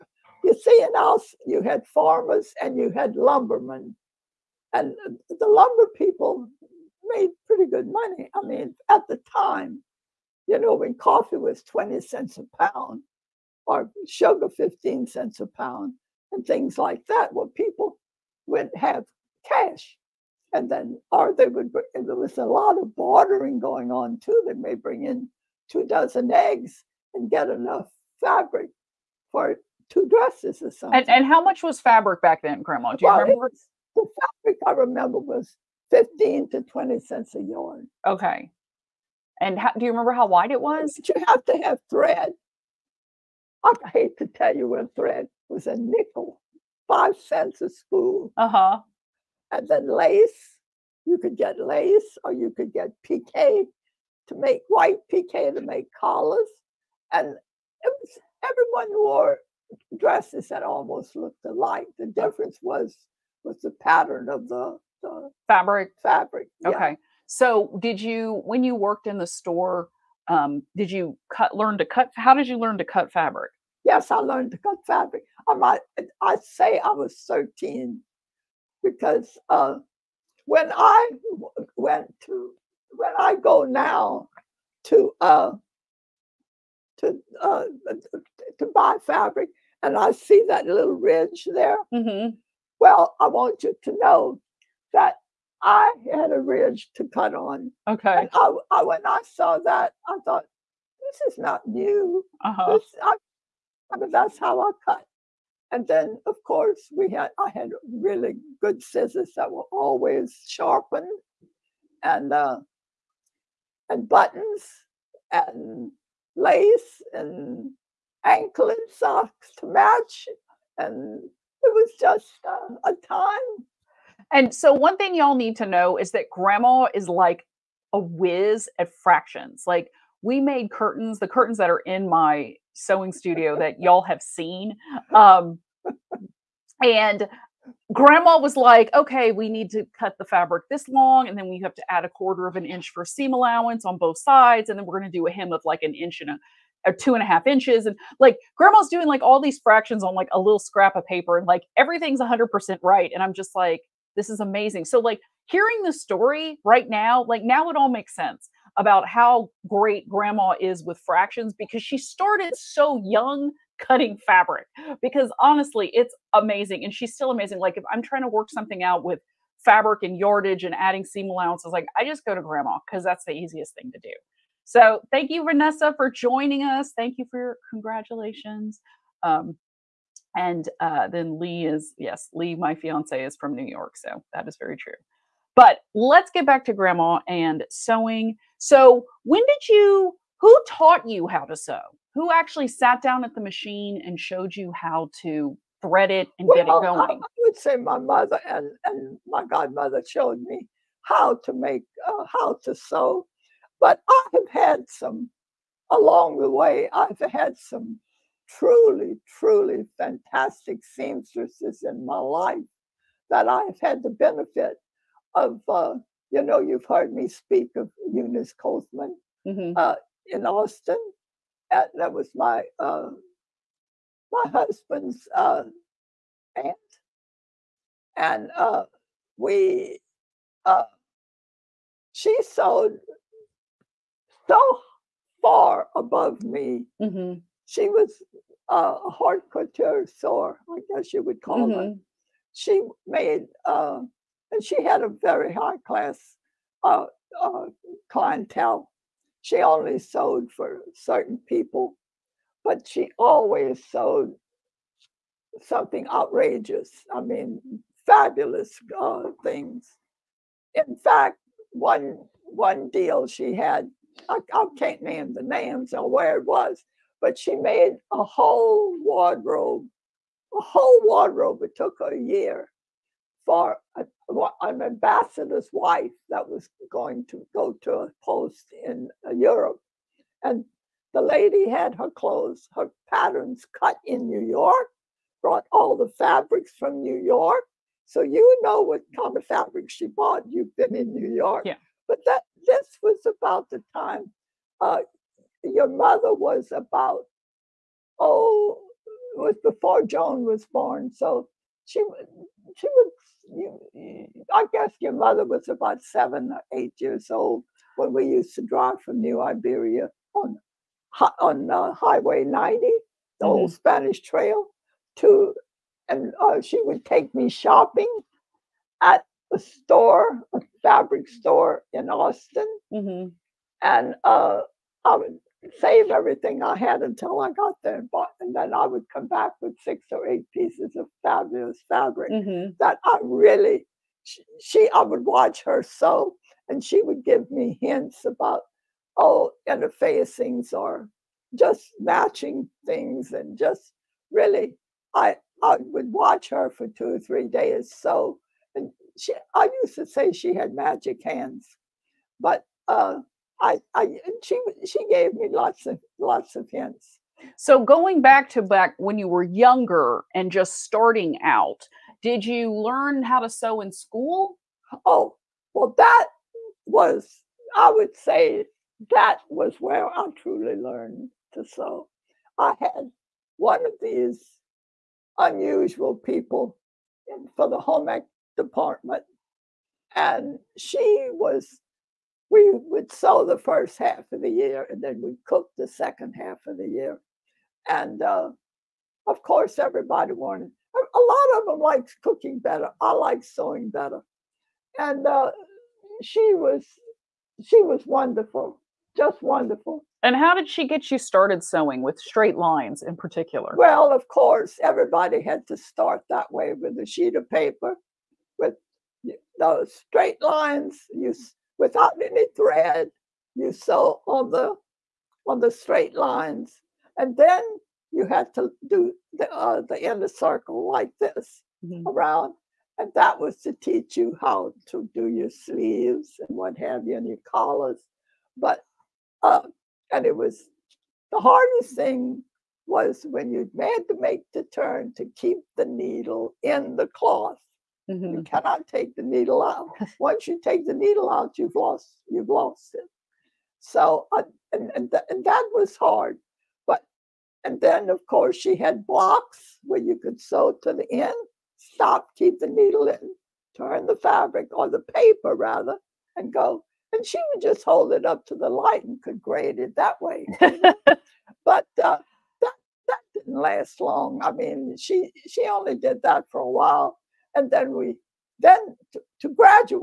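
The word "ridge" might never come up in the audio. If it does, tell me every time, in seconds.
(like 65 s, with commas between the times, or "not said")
90 s, 96 s.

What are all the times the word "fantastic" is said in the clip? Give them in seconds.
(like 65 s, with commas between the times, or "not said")
209 s.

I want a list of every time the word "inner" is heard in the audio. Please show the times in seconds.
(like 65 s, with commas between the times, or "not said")
420 s.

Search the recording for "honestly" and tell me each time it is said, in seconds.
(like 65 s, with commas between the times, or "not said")
165 s.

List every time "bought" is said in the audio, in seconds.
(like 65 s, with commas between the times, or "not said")
290 s, 328 s.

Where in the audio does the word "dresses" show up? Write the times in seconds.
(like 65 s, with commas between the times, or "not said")
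30 s, 59 s.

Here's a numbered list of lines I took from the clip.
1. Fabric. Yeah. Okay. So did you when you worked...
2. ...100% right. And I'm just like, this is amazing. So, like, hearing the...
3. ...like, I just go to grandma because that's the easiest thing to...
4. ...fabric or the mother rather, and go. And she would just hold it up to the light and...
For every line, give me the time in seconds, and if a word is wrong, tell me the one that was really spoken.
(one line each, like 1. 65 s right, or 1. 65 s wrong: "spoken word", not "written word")
1. 66 s right
2. 152 s right
3. 171 s right
4. 454 s wrong: "paper", not "mother".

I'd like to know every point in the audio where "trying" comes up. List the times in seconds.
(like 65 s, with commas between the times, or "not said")
168 s.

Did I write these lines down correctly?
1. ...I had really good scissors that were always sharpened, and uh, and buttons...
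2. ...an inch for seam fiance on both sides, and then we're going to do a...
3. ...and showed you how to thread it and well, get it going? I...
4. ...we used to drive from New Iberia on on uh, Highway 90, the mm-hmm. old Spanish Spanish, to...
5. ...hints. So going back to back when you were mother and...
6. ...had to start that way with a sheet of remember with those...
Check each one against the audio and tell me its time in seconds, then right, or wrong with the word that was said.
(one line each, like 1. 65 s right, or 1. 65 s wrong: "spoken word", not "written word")
1. 107 s right
2. 142 s wrong: "allowance", not "fiance"
3. 194 s right
4. 308 s wrong: "Trail", not "Spanish"
5. 356 s wrong: "younger", not "mother"
6. 405 s wrong: "paper", not "remember".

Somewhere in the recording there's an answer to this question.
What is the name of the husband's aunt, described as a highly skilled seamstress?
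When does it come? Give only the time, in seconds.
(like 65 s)
218 s.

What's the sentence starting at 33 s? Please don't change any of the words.
Was, the fabric I remember was 15 to 20 cents a yard.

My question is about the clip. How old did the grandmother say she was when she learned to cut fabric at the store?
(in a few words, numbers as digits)
13.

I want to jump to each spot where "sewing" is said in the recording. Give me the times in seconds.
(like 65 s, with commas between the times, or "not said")
132 s, 187 s, 393 s, 401 s.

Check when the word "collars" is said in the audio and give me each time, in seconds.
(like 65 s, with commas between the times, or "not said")
55 s, 427 s.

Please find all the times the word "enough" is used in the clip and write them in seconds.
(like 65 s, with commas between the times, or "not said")
27 s.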